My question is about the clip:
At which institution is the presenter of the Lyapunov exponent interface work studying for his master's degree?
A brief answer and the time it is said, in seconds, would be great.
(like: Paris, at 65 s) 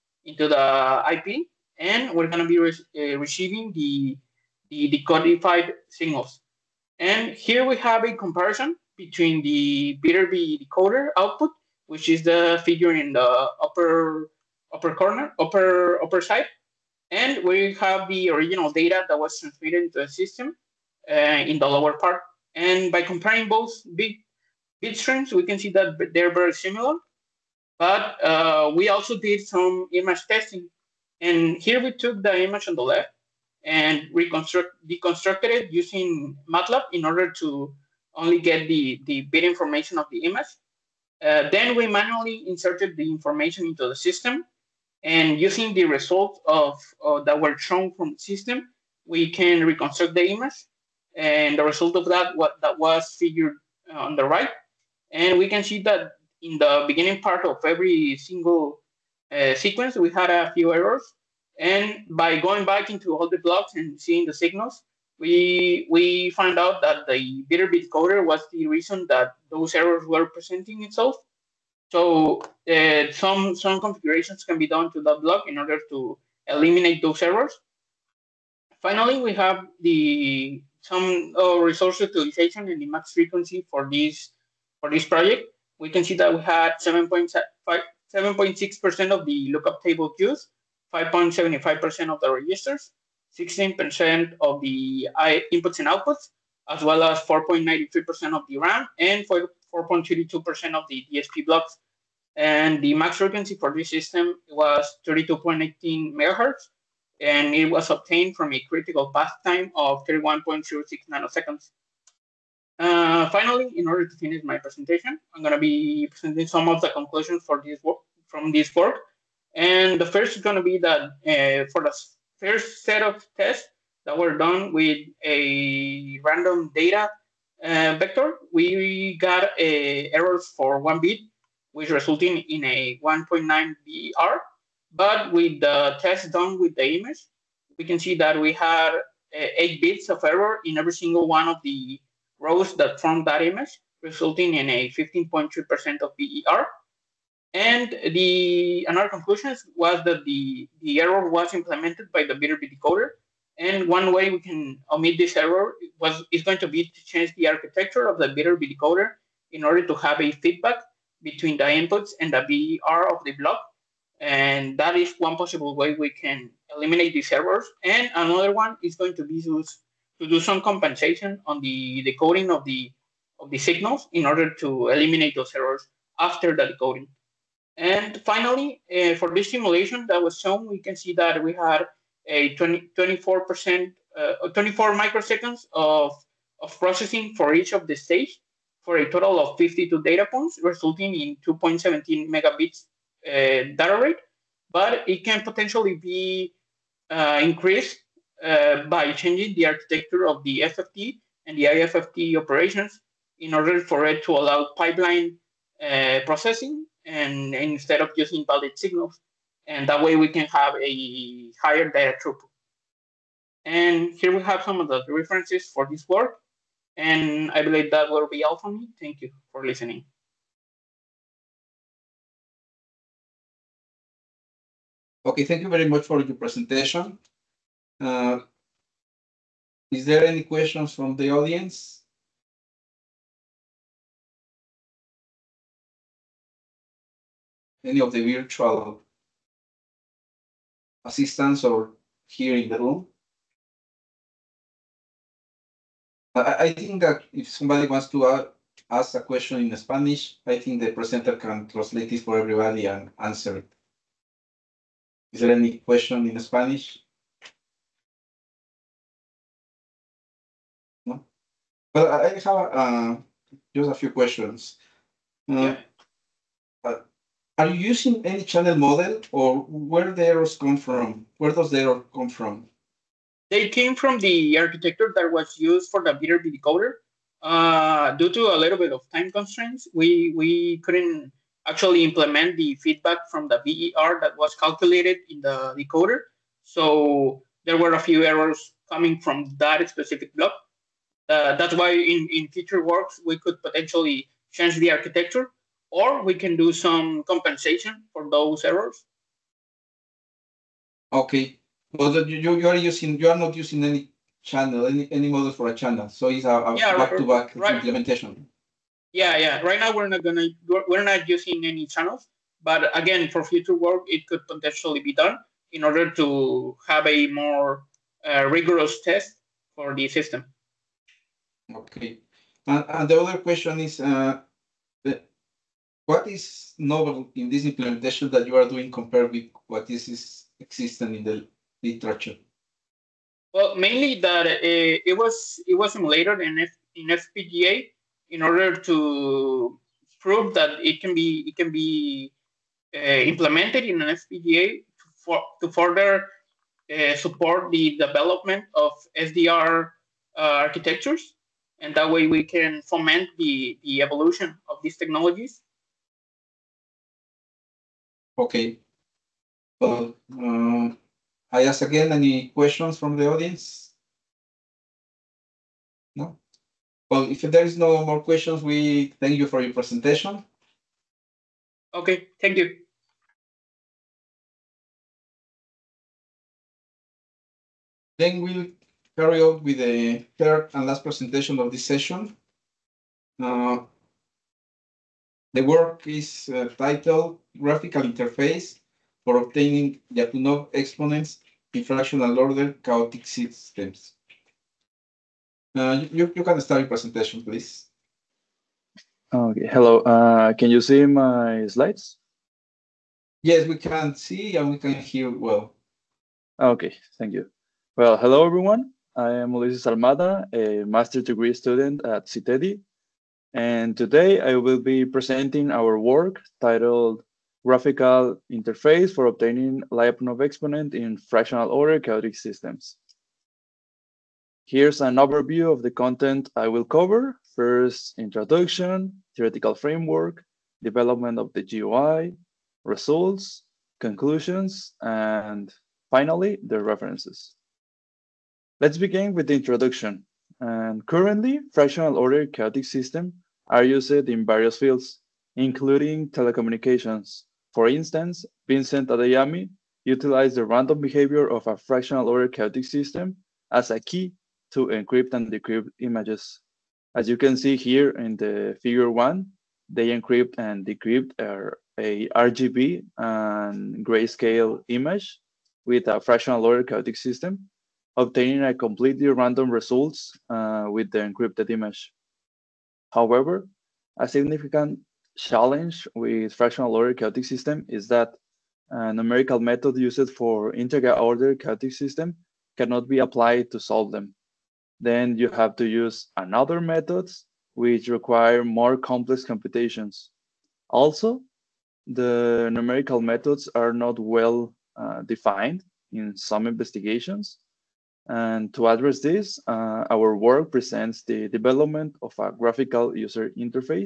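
CITEDI, at 412 s.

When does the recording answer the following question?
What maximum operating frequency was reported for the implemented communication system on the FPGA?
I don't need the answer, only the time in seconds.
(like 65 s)
105 s.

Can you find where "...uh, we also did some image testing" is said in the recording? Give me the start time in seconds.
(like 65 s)
28 s.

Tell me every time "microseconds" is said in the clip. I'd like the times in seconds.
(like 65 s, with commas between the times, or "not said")
184 s.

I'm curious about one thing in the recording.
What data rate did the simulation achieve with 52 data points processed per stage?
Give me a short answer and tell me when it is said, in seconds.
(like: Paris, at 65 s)
2.17 megabits, at 191 s.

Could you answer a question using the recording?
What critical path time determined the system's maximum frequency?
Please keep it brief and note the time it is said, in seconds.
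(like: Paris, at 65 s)
31.06 ns, at 110 s.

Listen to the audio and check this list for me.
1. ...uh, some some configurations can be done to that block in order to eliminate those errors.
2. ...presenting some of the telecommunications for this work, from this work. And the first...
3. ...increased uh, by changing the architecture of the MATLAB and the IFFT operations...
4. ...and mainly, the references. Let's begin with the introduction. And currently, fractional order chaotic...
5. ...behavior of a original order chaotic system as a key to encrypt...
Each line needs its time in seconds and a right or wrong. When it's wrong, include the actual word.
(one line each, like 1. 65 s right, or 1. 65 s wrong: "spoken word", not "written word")
1. 72 s right
2. 116 s wrong: "conclusions", not "telecommunications"
3. 197 s wrong: "FFT", not "MATLAB"
4. 435 s wrong: "finally", not "mainly"
5. 451 s wrong: "fractional", not "original".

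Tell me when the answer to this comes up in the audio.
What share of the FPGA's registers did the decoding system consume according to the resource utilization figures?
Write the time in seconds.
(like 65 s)
90 s.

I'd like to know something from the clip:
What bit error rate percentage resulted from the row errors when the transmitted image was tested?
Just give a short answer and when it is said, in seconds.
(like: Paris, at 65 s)
15.3%, at 144 s.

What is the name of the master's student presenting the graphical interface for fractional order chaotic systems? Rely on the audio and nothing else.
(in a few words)
Ulises Almada.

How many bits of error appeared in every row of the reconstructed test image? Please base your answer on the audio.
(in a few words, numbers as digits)
8.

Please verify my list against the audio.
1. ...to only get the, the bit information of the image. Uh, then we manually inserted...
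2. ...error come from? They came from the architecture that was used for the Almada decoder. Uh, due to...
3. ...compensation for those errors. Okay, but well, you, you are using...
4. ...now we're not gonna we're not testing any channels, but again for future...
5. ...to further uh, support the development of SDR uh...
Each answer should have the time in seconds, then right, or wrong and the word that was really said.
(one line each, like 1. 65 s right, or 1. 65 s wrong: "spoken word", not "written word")
1. 37 s right
2. 271 s wrong: "Viterbi", not "Almada"
3. 297 s right
4. 309 s wrong: "using", not "testing"
5. 345 s right.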